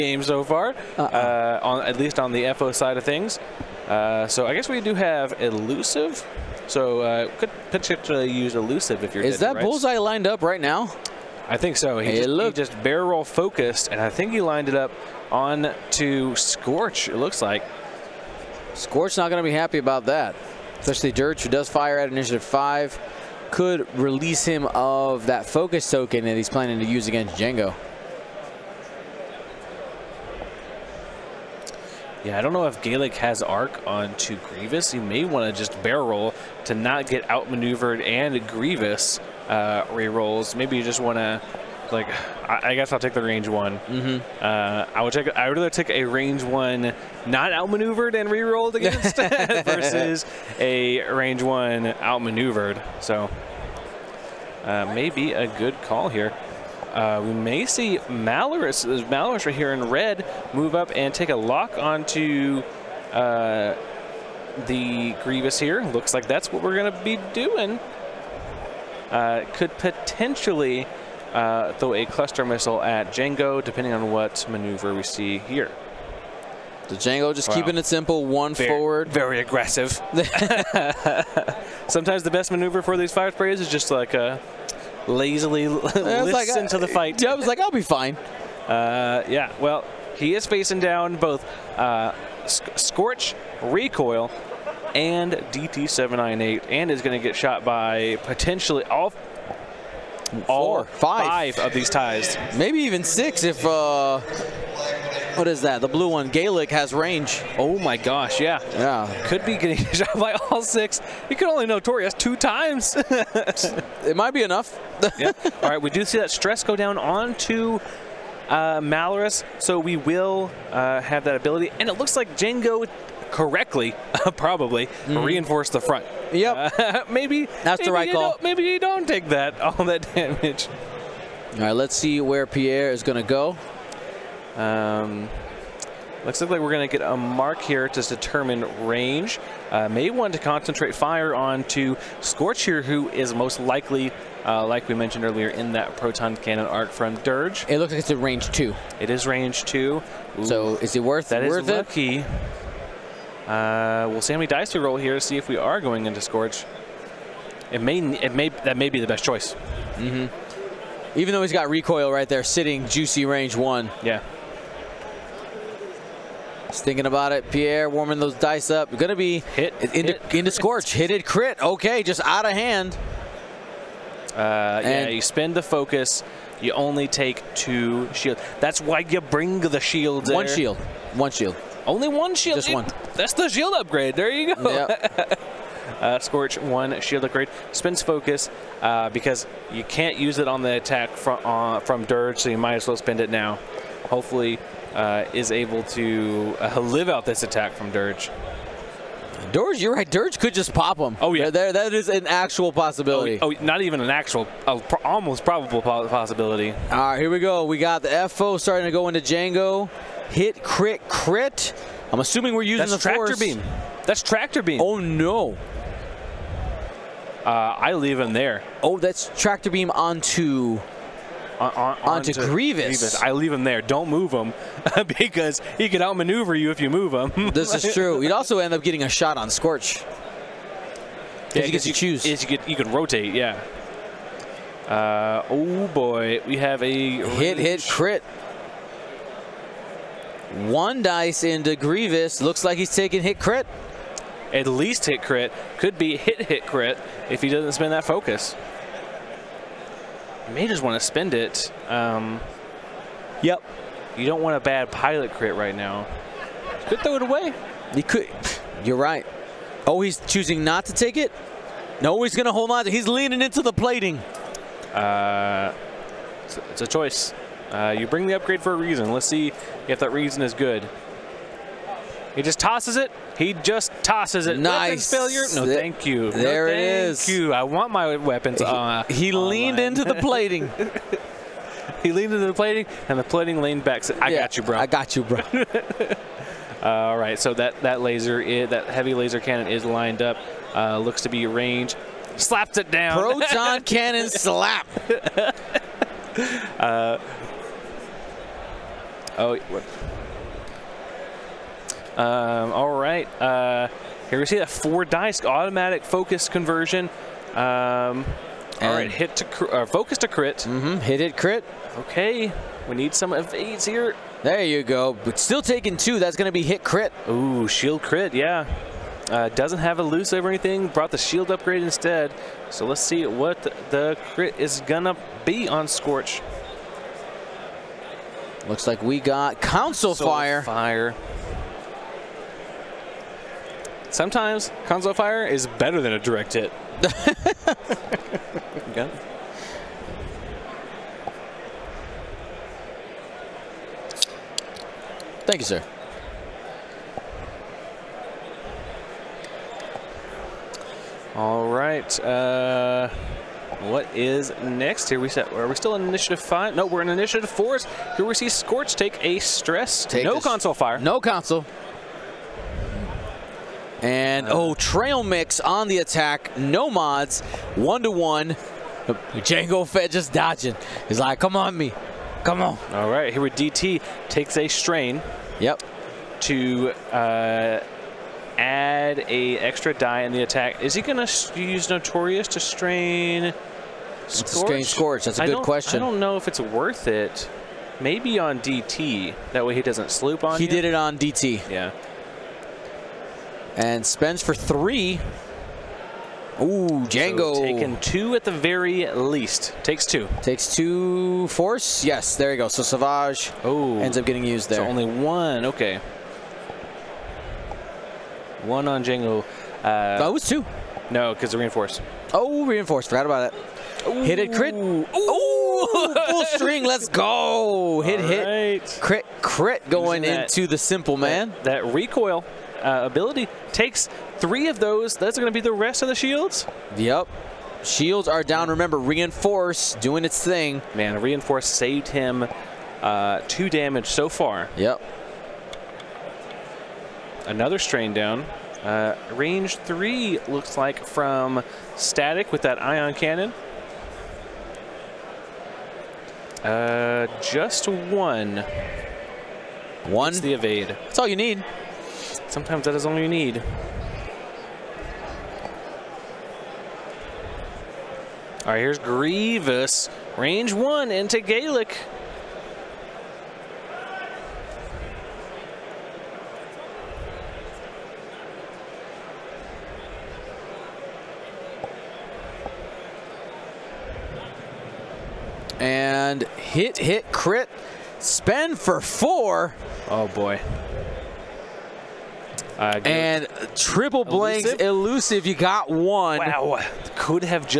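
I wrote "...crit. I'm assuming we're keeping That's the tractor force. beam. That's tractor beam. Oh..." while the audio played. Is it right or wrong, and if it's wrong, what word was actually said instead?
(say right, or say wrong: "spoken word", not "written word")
wrong: "using", not "keeping".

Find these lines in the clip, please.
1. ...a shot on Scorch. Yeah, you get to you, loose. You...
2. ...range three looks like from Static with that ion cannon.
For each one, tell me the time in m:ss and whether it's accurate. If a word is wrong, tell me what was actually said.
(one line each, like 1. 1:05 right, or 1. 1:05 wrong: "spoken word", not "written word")
1. 3:49 wrong: "choose", not "loose"
2. 7:19 right.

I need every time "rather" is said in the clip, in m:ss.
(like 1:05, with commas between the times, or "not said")
0:45.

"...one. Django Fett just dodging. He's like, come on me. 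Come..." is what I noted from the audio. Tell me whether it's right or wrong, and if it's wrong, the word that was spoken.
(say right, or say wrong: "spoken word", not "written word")
right.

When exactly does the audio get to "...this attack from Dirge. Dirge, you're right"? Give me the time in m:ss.
3:17.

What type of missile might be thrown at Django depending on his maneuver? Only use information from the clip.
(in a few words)
cluster missile.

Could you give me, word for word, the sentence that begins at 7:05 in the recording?
Those are going to be the rest of the shields.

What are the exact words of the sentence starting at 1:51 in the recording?
You could only Notorious two times.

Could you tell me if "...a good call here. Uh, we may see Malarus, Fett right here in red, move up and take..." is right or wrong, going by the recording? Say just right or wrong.
wrong.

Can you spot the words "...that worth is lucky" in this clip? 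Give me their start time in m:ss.
2:31.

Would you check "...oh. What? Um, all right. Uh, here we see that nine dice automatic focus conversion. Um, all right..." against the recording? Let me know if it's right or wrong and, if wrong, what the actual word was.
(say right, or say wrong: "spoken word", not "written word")
wrong: "four", not "nine".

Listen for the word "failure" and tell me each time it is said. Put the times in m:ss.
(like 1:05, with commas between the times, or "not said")
4:35.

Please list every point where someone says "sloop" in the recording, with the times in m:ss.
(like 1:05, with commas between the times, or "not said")
6:30.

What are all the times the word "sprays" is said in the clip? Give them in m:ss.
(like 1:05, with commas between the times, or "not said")
1:23.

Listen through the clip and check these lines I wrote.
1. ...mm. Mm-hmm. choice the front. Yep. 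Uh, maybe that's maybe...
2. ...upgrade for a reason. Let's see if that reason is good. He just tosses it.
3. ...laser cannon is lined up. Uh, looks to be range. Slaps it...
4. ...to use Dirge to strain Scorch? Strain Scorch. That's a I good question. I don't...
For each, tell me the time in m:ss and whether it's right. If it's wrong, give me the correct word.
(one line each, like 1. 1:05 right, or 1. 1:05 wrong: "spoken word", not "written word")
1. 2:04 wrong: "reinforce", not "choice"
2. 4:28 right
3. 4:49 right
4. 6:21 wrong: "Notorious", not "Dirge".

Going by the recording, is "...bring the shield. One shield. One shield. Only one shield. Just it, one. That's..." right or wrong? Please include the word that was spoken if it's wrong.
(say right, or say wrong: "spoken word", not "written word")
right.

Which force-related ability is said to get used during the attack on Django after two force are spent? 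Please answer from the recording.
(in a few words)
Savage.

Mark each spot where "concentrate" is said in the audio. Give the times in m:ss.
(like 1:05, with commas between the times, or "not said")
2:20.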